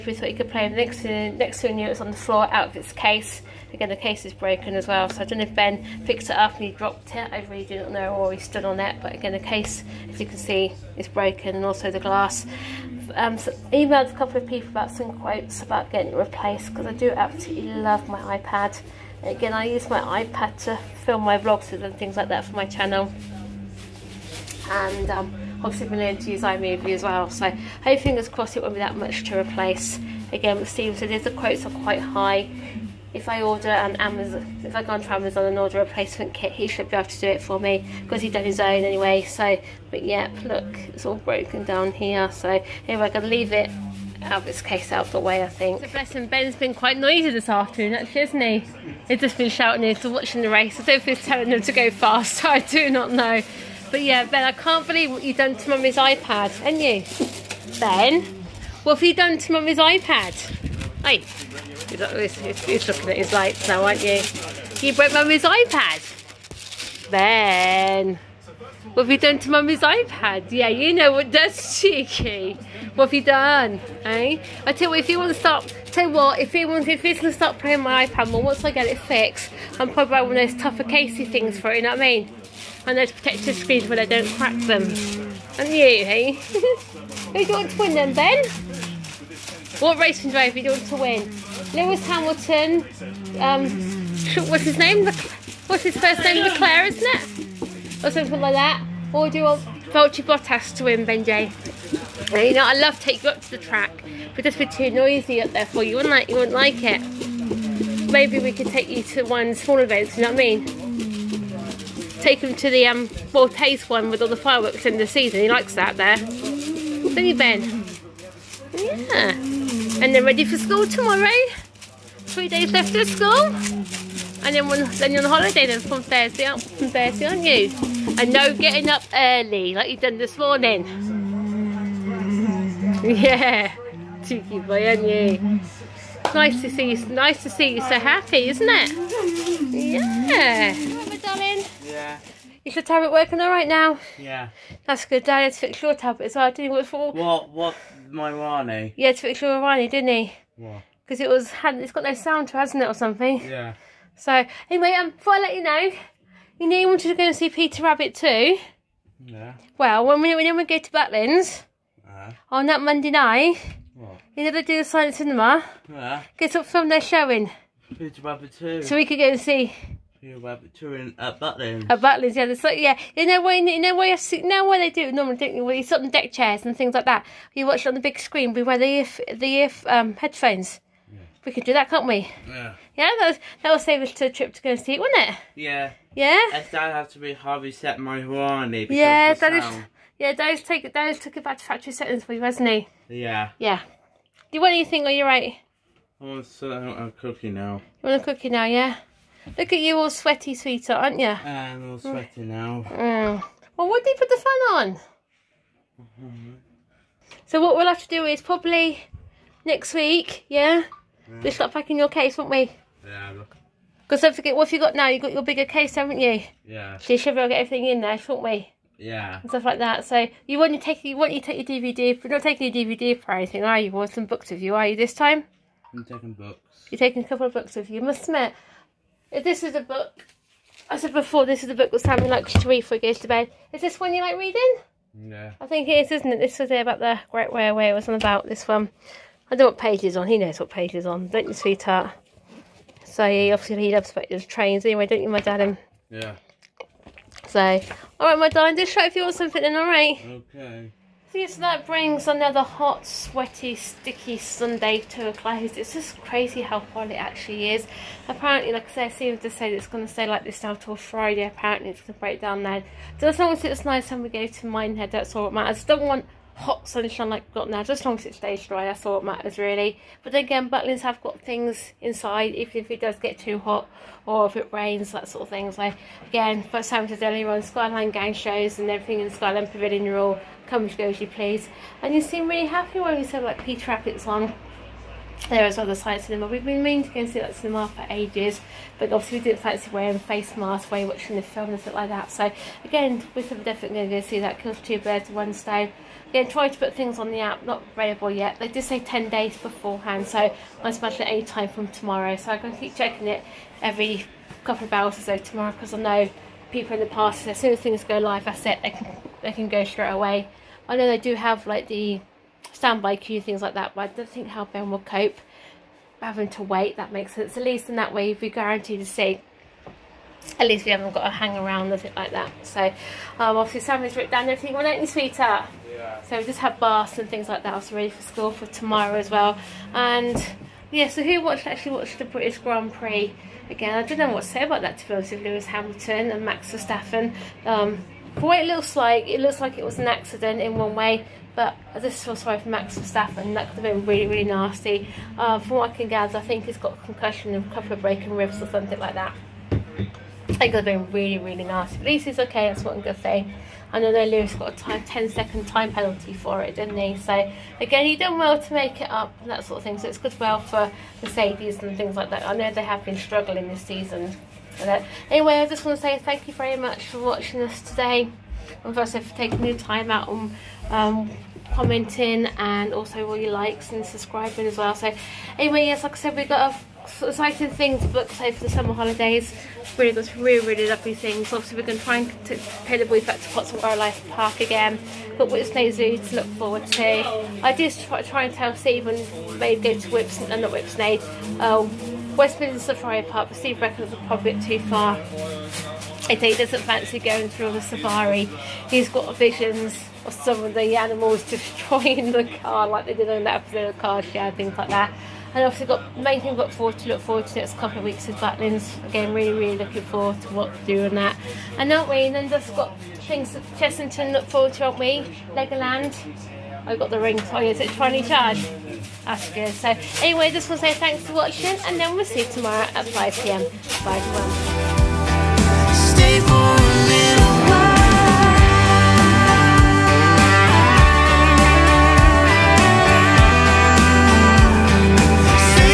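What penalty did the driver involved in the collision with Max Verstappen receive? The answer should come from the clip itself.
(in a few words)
10 second time penalty.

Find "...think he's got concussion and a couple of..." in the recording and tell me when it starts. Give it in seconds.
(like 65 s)
346 s.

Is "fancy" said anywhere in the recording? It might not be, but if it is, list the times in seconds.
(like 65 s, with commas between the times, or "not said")
289 s, 396 s.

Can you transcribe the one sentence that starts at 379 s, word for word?
Really got some really, really lovely things.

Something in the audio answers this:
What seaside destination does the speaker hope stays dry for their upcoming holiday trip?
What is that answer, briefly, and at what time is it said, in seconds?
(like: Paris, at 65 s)
Minehead, at 264 s.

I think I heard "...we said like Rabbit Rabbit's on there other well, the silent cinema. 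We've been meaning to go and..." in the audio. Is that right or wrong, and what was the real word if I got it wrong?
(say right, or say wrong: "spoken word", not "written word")
wrong: "Peter", not "Rabbit".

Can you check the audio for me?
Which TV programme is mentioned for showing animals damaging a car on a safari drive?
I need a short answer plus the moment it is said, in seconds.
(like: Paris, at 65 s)
Car Share, at 403 s.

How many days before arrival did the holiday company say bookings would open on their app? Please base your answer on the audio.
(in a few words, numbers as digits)
10.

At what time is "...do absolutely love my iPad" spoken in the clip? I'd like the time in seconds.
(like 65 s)
16 s.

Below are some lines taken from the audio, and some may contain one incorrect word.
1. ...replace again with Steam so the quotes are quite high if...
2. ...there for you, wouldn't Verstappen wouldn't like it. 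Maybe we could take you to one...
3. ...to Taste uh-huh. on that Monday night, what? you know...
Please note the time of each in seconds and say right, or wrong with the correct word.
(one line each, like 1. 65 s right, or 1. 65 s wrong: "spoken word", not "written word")
1. 29 s right
2. 105 s wrong: "You", not "Verstappen"
3. 160 s wrong: "Butlins", not "Taste".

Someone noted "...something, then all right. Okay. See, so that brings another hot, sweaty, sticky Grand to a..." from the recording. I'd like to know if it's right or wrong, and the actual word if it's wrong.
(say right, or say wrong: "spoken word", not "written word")
wrong: "Sunday", not "Grand".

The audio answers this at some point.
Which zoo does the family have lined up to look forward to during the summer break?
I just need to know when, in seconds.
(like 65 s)
385 s.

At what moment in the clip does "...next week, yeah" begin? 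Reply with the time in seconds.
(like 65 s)
209 s.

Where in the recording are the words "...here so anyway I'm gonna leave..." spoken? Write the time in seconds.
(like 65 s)
41 s.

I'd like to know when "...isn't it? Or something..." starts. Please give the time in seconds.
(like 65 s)
96 s.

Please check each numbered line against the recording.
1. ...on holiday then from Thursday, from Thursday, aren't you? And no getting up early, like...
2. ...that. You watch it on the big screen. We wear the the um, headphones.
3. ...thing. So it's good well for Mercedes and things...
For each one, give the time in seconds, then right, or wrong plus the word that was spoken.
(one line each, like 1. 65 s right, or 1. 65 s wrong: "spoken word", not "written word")
1. 125 s right
2. 177 s right
3. 359 s right.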